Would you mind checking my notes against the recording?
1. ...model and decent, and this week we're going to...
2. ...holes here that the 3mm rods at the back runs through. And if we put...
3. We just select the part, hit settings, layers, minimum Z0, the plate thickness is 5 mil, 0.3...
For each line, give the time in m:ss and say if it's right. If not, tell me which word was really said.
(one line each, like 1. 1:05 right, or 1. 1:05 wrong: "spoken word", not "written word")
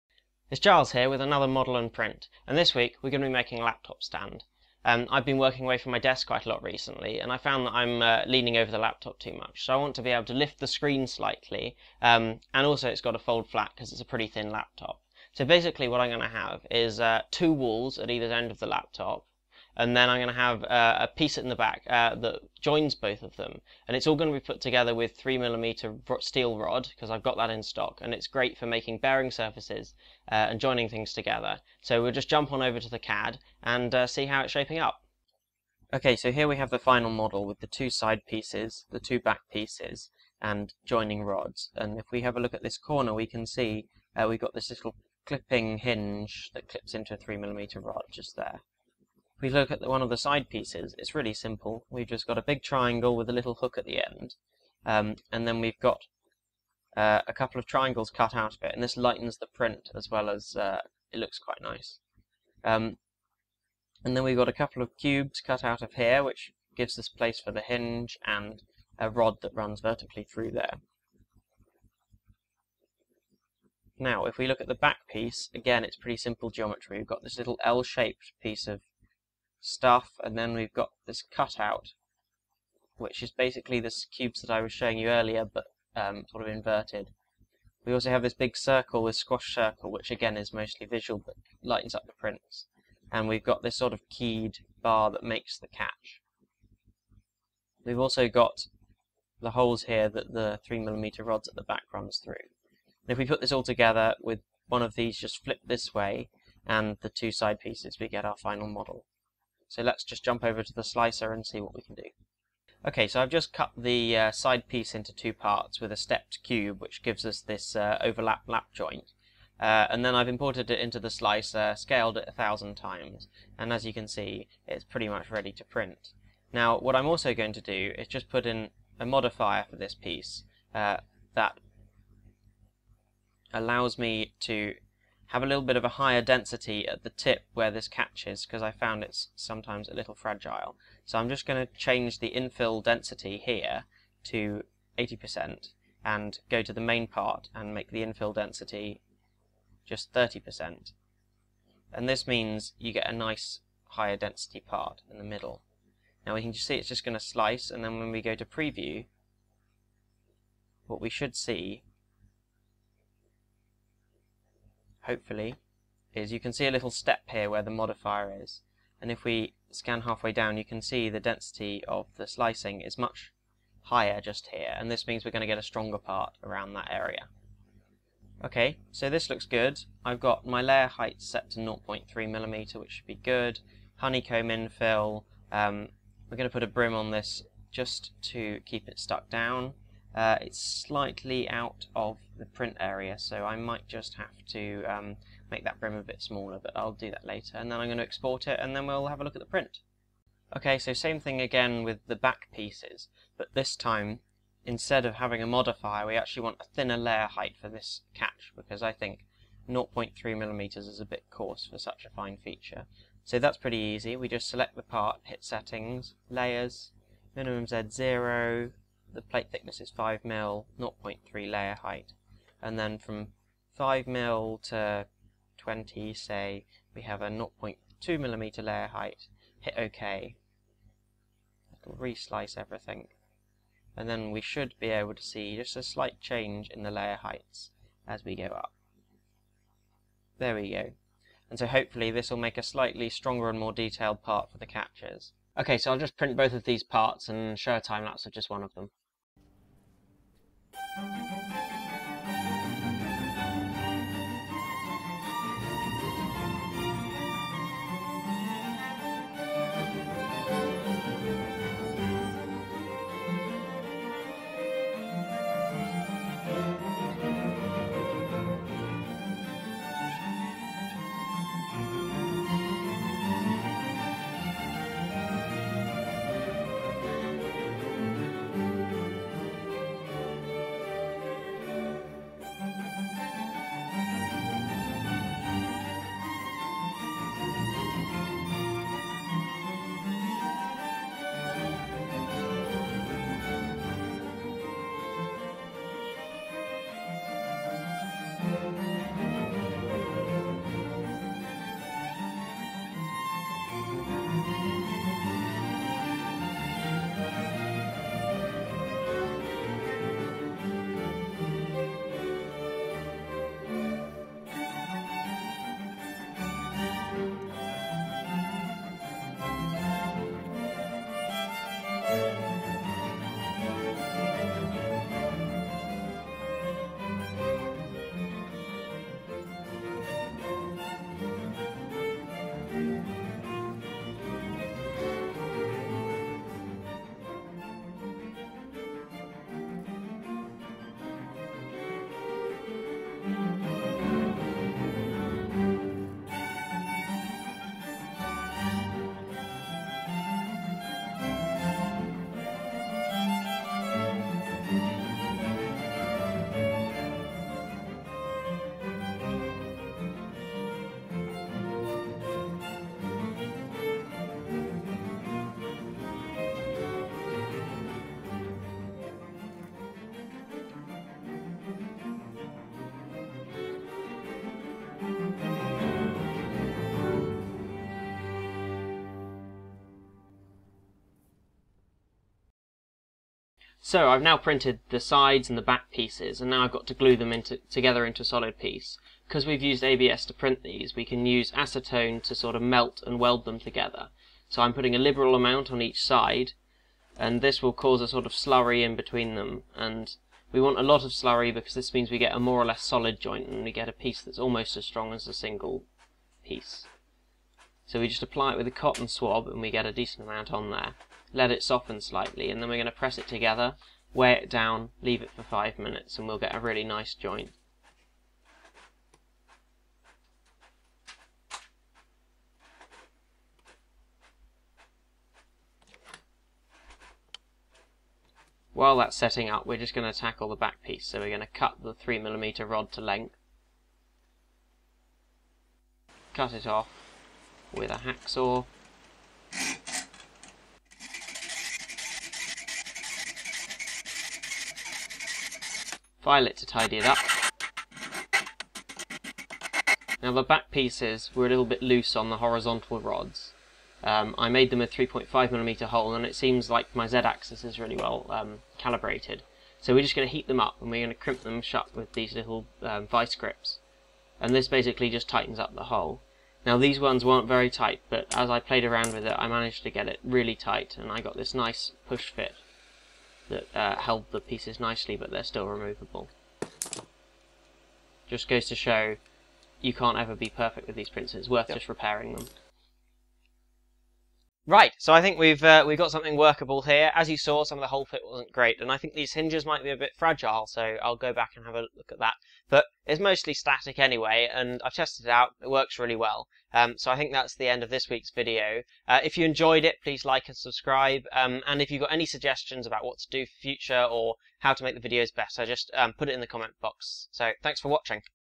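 1. 0:01 wrong: "print", not "decent"
2. 1:39 right
3. 3:34 right.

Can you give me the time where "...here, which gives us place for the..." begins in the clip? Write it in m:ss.
1:05.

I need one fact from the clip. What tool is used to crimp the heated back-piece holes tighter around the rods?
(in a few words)
vice grips.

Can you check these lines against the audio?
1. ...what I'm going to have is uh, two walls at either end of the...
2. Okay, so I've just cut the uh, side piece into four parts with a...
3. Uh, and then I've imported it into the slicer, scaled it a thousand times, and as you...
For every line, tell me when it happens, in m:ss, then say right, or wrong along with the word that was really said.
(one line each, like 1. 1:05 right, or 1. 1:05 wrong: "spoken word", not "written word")
1. 0:15 right
2. 1:52 wrong: "two", not "four"
3. 1:59 right.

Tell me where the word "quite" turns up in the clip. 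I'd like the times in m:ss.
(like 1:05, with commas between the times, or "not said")
0:06, 1:01.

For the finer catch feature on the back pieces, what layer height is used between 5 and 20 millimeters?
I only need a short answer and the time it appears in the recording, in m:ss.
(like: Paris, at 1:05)
0.2 millimeter, at 3:47.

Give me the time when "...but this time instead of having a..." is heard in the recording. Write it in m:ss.
3:23.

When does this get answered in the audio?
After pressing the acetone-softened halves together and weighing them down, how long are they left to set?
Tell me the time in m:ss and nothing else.
6:55.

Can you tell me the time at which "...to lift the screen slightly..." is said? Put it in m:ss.
0:10.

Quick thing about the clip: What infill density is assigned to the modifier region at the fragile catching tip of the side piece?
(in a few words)
80%.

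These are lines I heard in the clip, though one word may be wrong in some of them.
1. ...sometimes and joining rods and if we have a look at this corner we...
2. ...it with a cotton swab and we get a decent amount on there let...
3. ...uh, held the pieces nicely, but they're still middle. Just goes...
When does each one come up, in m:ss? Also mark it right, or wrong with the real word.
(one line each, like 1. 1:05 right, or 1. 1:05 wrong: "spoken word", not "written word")
1. 0:39 wrong: "pieces", not "sometimes"
2. 6:48 right
3. 7:53 wrong: "removable", not "middle".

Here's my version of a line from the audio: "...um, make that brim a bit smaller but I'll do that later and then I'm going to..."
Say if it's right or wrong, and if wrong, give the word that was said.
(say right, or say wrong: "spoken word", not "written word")
right.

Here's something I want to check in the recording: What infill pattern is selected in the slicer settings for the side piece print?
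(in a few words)
Honeycomb.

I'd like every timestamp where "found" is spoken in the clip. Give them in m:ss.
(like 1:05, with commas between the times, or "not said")
0:07, 2:18.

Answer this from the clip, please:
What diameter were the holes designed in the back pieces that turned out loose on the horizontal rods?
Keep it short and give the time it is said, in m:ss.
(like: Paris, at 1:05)
3.5mm, at 7:34.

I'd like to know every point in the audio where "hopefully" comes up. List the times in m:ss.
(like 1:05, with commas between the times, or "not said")
2:45, 4:01.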